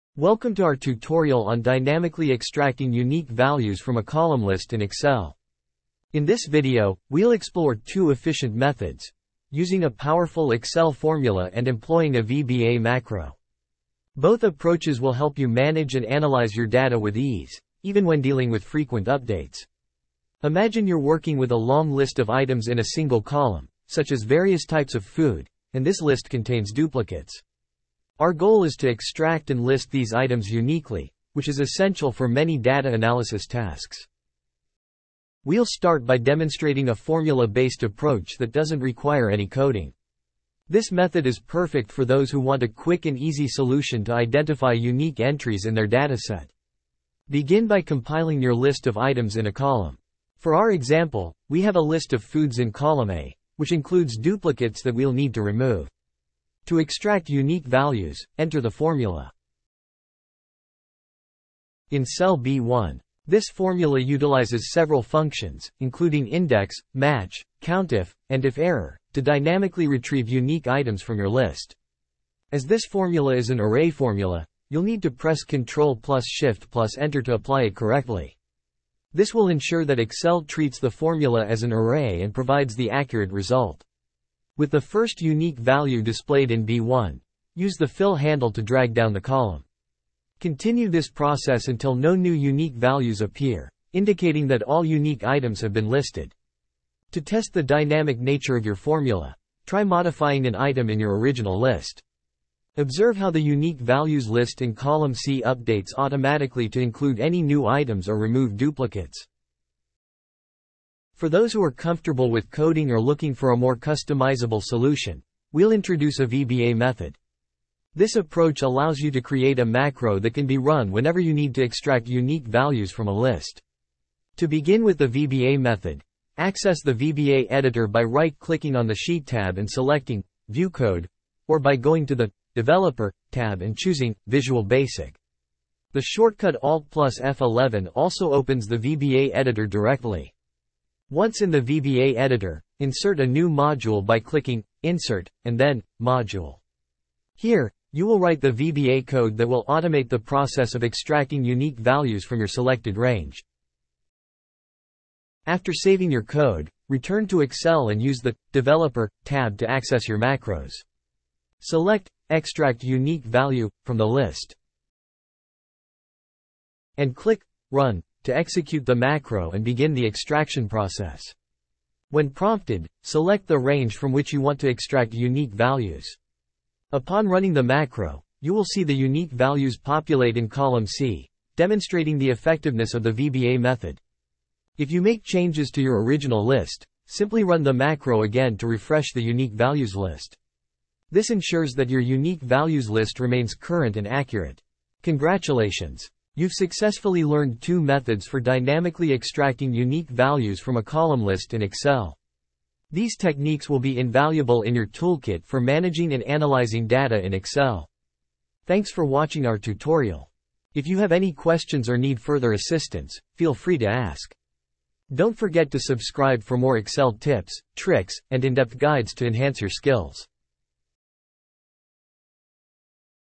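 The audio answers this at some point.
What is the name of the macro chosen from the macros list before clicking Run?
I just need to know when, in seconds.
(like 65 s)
162 s.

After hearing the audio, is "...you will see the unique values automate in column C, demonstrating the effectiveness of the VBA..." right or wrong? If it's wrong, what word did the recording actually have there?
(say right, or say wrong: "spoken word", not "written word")
wrong: "populate", not "automate".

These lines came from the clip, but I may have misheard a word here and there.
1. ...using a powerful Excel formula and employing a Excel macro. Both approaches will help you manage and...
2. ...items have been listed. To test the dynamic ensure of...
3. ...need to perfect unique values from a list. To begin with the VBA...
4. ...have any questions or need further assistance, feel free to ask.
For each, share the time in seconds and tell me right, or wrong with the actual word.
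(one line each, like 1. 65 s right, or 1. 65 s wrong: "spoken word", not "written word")
1. 9 s wrong: "VBA", not "Excel"
2. 95 s wrong: "nature", not "ensure"
3. 121 s wrong: "extract", not "perfect"
4. 210 s right.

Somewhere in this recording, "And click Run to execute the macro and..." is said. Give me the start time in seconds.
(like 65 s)
166 s.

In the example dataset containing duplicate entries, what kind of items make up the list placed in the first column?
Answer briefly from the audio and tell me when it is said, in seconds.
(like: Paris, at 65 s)
Foods, at 51 s.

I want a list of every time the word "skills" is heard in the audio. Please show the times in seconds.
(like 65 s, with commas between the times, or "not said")
219 s.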